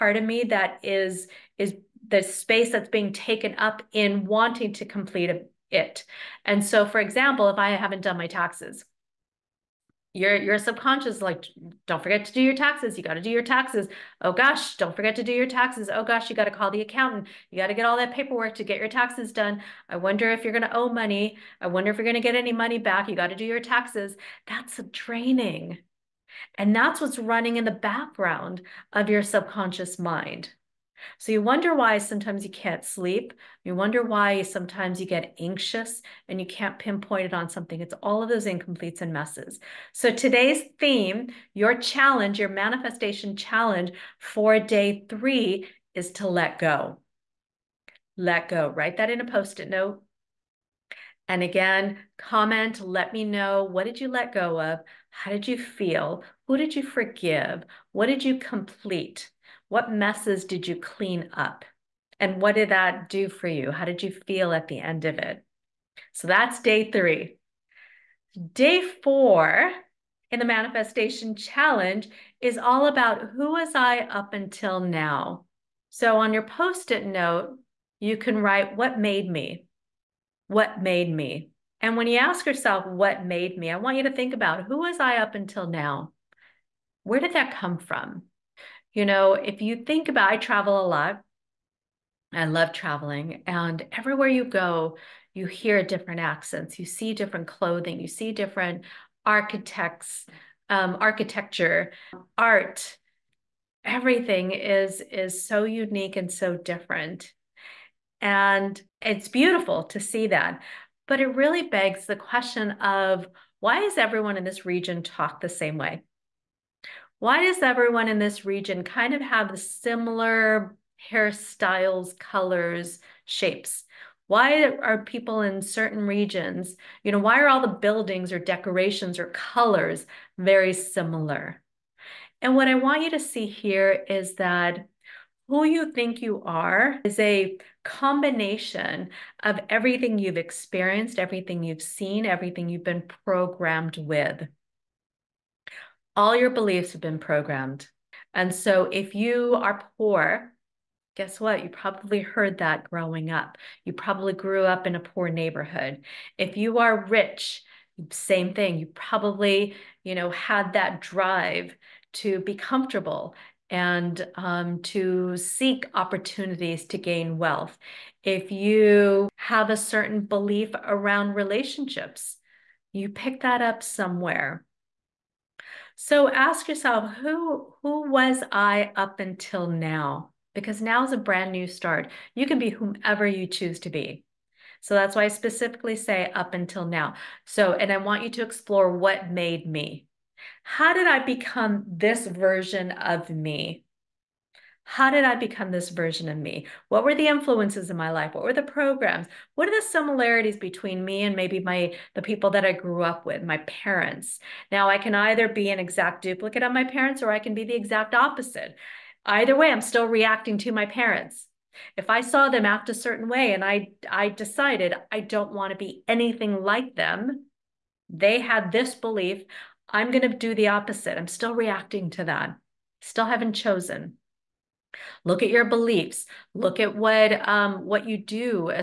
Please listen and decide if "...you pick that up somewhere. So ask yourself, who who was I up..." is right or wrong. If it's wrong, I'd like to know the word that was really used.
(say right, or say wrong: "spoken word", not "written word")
right.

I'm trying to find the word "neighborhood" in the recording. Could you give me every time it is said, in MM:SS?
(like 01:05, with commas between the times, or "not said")
02:35.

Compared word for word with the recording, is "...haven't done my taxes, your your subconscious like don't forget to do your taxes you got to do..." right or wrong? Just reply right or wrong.
right.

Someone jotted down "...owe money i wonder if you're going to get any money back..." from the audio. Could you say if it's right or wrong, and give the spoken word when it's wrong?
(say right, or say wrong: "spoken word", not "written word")
right.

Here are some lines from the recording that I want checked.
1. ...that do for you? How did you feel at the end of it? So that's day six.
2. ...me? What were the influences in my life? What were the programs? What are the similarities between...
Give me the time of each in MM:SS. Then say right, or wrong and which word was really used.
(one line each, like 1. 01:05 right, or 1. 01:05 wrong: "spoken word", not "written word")
1. 01:02 wrong: "three", not "six"
2. 03:16 right.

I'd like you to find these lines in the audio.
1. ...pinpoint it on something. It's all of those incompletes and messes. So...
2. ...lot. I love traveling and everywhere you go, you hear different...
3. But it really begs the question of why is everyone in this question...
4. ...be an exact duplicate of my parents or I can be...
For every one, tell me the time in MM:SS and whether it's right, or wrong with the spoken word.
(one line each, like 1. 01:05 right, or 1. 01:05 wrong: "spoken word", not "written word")
1. 00:36 right
2. 01:30 right
3. 01:51 wrong: "region", not "question"
4. 03:25 right.